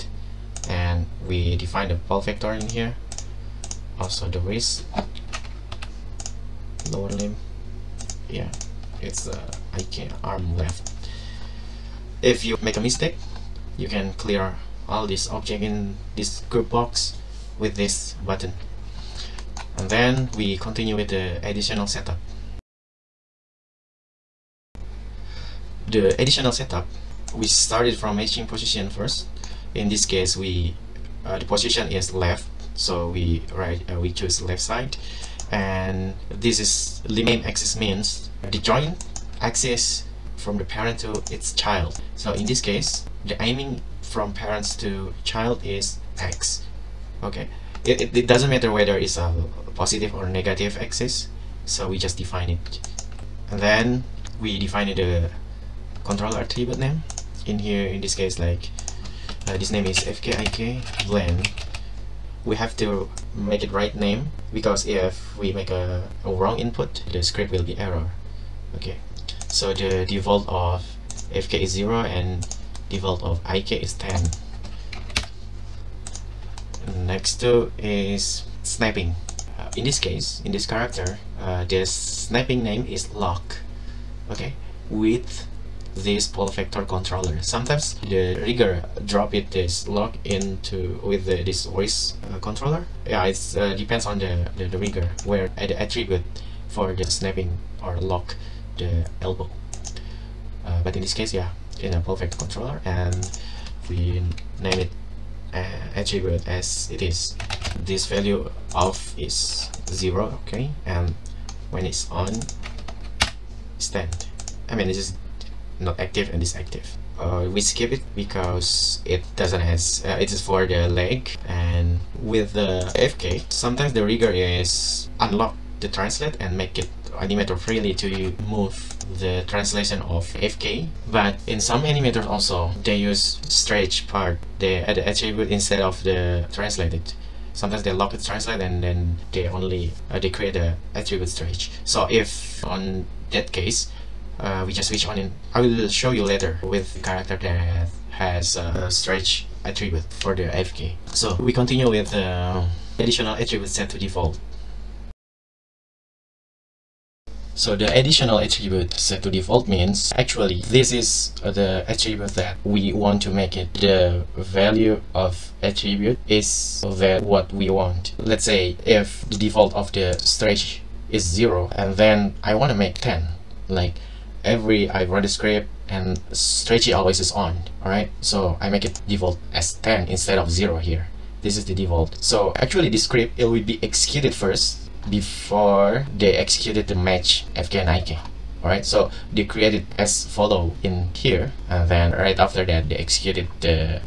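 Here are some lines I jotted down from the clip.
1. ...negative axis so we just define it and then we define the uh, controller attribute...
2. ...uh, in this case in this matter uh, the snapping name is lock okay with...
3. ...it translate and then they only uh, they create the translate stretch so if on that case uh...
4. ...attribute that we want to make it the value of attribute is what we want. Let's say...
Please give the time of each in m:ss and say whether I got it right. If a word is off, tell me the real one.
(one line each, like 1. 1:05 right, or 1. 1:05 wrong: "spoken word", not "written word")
1. 0:50 right
2. 1:19 wrong: "character", not "matter"
3. 2:18 wrong: "attribute", not "translate"
4. 2:41 right.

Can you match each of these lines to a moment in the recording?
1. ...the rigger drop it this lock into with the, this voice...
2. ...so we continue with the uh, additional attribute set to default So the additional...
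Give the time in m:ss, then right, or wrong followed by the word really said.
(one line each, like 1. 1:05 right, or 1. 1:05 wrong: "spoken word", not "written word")
1. 1:28 right
2. 2:31 right.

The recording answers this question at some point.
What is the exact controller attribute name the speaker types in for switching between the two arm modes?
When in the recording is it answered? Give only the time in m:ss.
0:59.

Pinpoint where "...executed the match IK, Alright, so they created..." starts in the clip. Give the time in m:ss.
3:06.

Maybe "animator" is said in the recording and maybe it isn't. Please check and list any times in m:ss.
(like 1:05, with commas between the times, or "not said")
2:07, 2:11.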